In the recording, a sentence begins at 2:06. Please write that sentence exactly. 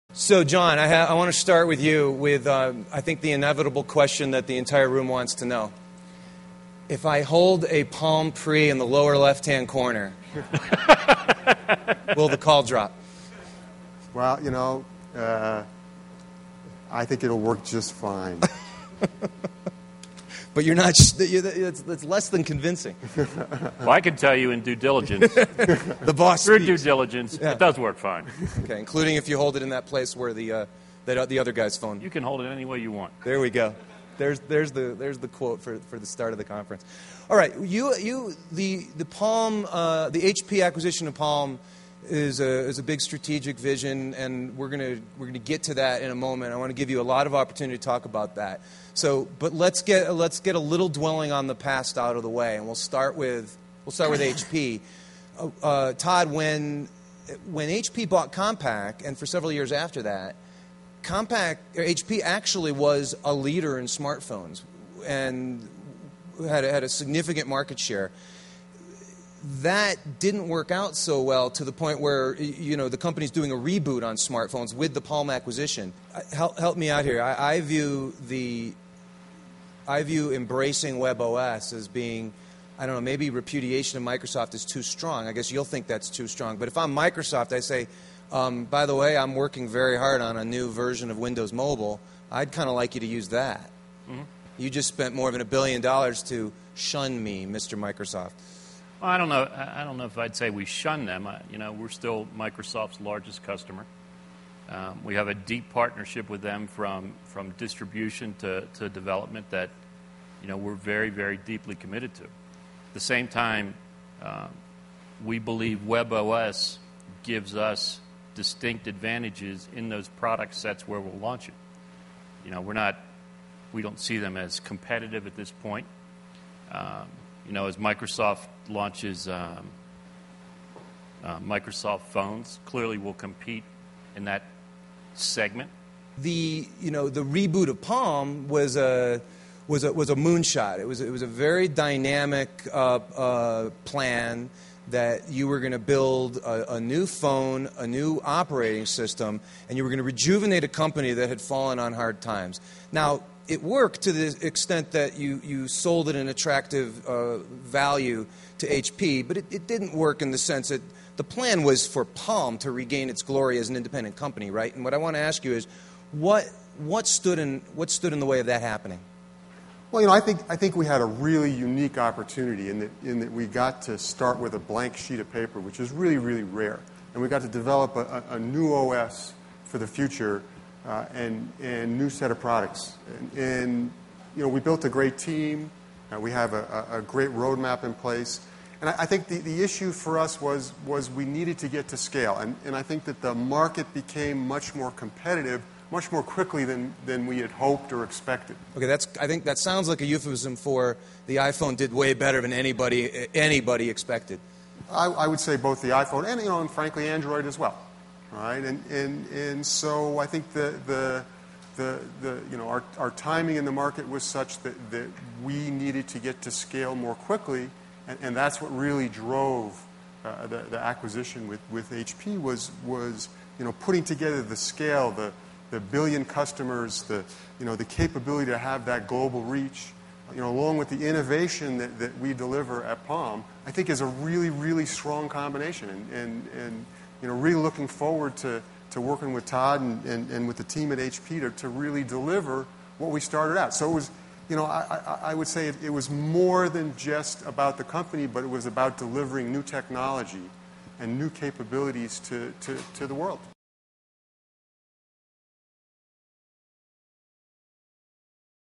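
Um, you know, as Microsoft launches um, uh, Microsoft phones, clearly will compete in that segment.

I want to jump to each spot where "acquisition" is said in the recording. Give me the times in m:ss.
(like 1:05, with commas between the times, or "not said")
0:40, 1:15, 3:40.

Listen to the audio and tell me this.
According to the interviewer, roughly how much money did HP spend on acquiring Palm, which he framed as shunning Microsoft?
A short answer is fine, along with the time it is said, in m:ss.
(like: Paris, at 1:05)
more than a billion dollars, at 1:35.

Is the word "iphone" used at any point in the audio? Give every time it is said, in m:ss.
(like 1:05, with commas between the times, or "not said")
3:21, 3:25.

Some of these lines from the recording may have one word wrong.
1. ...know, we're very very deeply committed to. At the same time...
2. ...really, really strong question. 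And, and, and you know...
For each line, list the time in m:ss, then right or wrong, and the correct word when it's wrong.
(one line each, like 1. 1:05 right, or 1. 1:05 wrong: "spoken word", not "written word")
1. 1:50 right
2. 3:54 wrong: "combination", not "question".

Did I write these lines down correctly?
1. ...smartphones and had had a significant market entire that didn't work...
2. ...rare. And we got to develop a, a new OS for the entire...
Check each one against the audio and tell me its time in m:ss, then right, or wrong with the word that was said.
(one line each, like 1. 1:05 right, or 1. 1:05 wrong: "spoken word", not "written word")
1. 1:03 wrong: "share", not "entire"
2. 2:56 wrong: "future", not "entire".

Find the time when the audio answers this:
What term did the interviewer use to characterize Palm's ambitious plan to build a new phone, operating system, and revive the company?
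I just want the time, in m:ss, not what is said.
2:20.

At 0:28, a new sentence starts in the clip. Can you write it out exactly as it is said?
Okay, including if you hold it in that place where the, uh, that, uh, the other guy's phone.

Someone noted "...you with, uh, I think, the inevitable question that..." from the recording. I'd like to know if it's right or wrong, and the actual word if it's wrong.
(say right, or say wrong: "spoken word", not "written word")
right.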